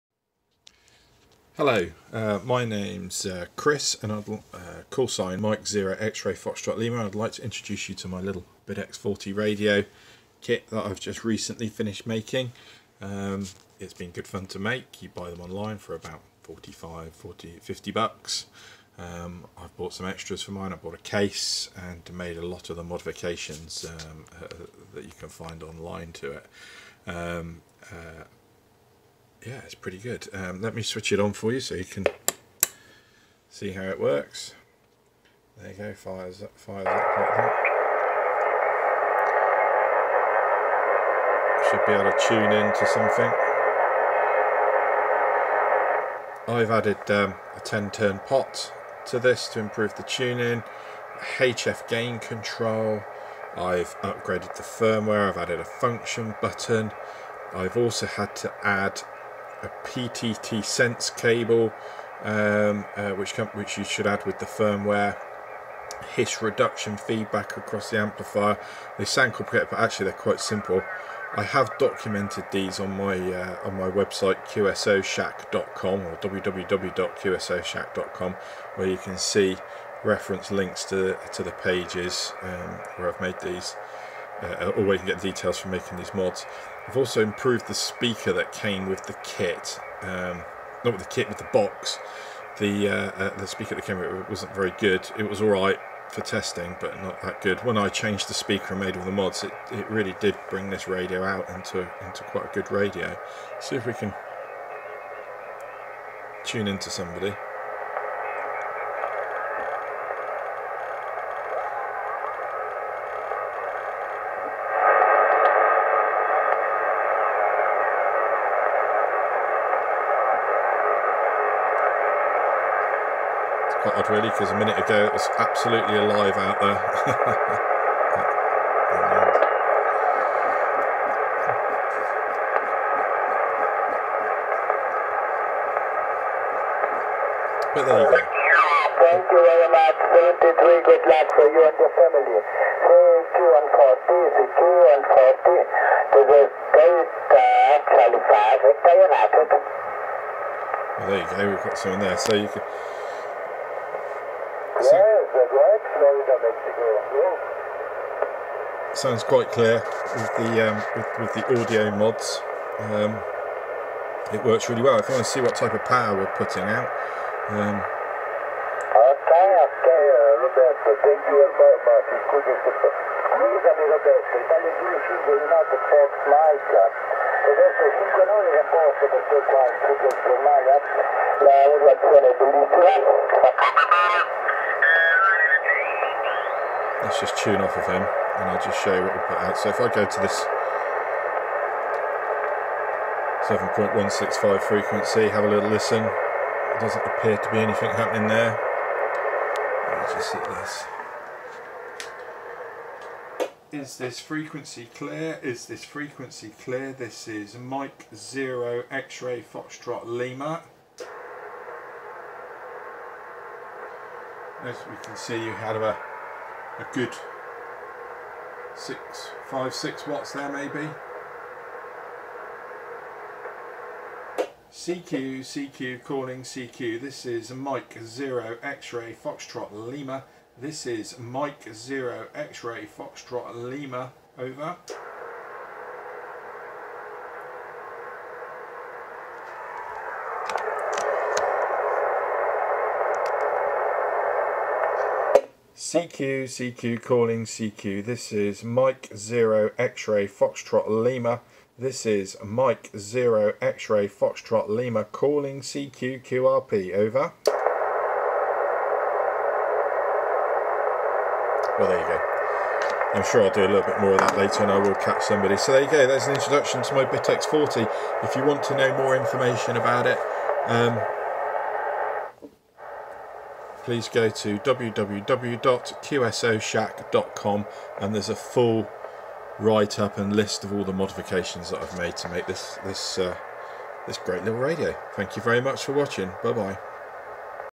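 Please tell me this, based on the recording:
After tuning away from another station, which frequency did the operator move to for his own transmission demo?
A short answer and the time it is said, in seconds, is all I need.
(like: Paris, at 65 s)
7.165, at 194 s.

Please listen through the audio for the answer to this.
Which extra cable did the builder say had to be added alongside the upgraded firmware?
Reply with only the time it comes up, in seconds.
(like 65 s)
59 s.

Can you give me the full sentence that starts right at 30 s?
Um, let me switch it on for you so you can see how it works.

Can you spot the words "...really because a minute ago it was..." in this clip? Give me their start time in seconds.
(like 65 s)
124 s.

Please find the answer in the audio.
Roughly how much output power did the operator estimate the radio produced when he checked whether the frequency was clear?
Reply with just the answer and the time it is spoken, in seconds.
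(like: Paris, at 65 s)
6 watts, at 219 s.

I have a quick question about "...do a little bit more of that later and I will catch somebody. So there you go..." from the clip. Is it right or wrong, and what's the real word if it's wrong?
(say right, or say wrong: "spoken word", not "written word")
right.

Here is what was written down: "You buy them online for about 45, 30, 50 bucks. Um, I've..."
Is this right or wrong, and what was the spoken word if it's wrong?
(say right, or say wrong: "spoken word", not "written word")
wrong: "40", not "30".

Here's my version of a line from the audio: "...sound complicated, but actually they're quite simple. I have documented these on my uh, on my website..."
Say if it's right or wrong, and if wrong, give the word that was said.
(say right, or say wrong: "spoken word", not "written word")
right.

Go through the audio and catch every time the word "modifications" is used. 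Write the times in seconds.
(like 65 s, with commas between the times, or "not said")
22 s, 280 s.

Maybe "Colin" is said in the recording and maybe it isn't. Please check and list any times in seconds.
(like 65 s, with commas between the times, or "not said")
not said.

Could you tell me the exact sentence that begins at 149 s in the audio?
Uh, well, there you go, we've got someone there.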